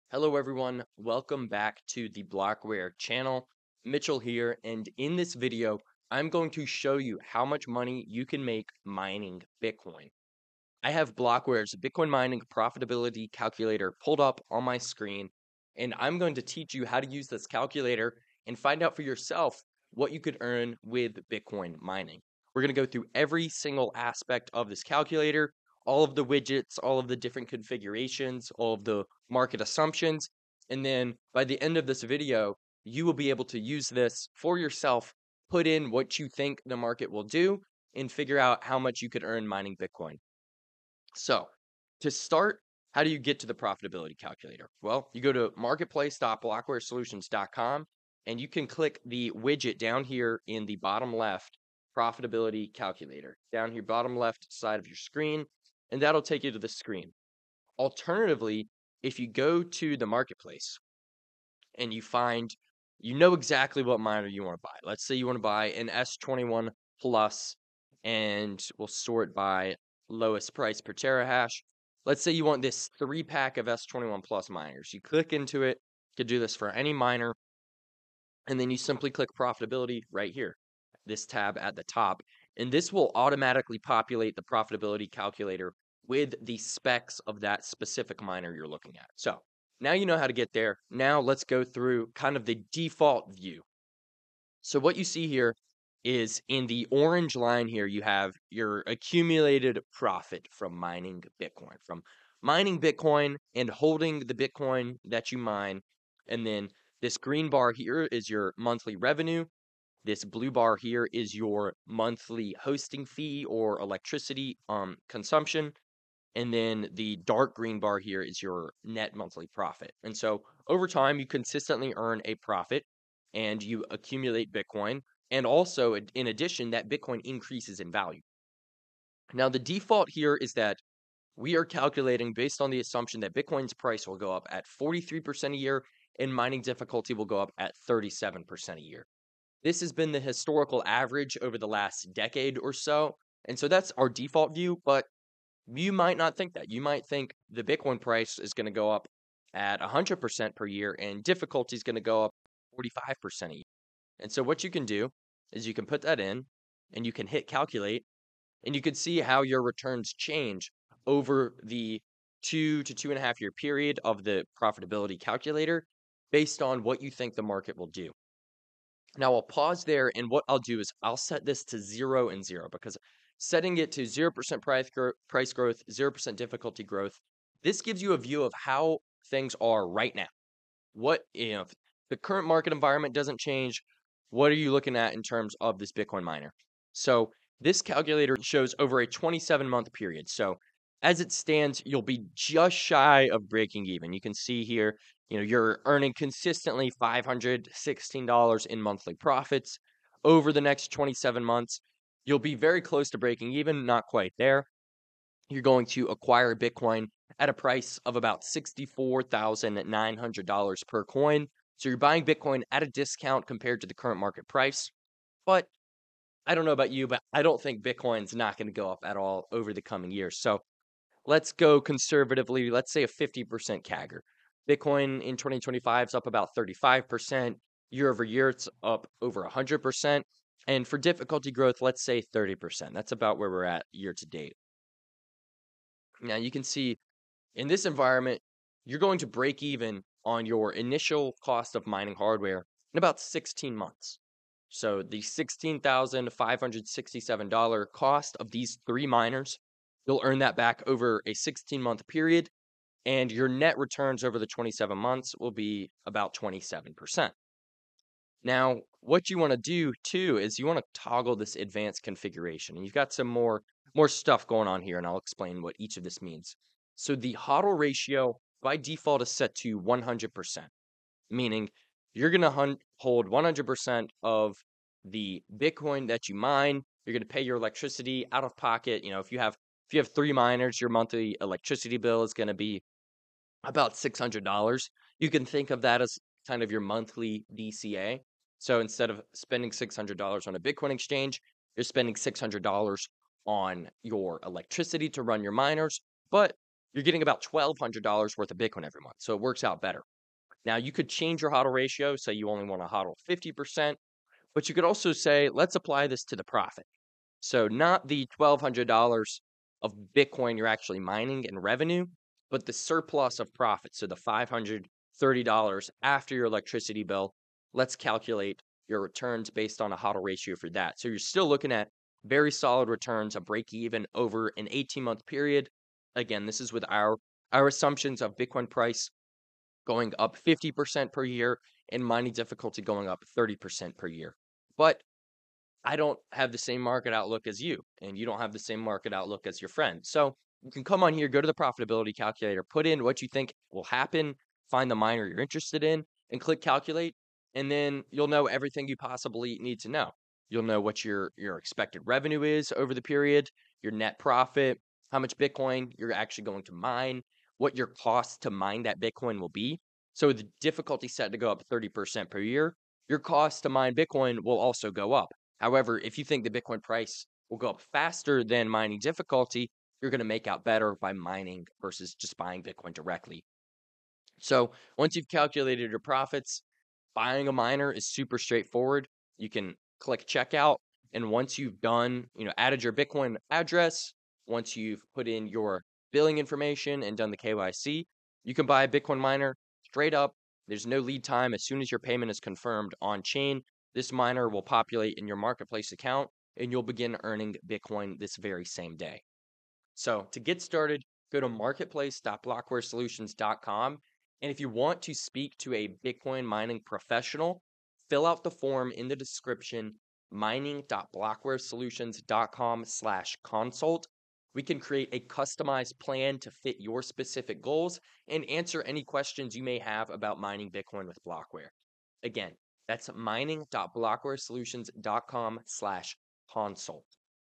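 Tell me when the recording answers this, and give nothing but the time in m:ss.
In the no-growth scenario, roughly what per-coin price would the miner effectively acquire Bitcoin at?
3:28.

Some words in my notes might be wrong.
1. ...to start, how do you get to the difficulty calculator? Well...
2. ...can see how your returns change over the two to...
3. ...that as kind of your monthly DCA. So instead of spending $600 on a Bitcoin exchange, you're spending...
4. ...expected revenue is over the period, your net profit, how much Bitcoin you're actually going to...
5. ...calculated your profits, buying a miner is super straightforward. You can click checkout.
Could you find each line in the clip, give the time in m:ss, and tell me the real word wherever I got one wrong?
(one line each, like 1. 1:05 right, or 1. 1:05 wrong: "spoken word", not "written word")
1. 0:41 wrong: "profitability", not "difficulty"
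2. 2:38 right
3. 4:45 right
4. 5:51 right
5. 6:15 right.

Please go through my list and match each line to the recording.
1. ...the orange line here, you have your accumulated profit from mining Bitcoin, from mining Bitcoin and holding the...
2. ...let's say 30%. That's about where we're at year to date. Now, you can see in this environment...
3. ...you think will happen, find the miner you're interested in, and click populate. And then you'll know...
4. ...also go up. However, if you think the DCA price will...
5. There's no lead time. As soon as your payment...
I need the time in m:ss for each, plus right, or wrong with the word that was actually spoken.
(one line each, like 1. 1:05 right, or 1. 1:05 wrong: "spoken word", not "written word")
1. 1:36 right
2. 3:51 right
3. 5:43 wrong: "calculate", not "populate"
4. 6:04 wrong: "Bitcoin", not "DCA"
5. 6:30 right.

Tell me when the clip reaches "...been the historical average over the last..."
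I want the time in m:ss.
2:19.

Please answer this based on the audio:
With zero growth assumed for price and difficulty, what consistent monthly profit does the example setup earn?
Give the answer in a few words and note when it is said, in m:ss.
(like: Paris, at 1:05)
$516, at 3:17.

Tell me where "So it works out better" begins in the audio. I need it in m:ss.
4:59.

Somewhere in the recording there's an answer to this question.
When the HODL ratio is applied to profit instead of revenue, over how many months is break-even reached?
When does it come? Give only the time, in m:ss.
5:24.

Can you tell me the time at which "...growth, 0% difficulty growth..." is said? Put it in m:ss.
2:55.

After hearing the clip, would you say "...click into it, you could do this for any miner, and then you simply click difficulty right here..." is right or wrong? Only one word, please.
wrong.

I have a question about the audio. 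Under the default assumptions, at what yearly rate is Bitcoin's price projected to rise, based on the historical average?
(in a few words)
43%.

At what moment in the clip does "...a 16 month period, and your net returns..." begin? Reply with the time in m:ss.
4:11.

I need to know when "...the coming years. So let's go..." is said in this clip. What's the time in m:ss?
3:39.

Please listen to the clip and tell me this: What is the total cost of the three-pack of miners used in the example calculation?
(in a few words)
$16,567.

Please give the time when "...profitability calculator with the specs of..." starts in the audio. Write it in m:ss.
1:24.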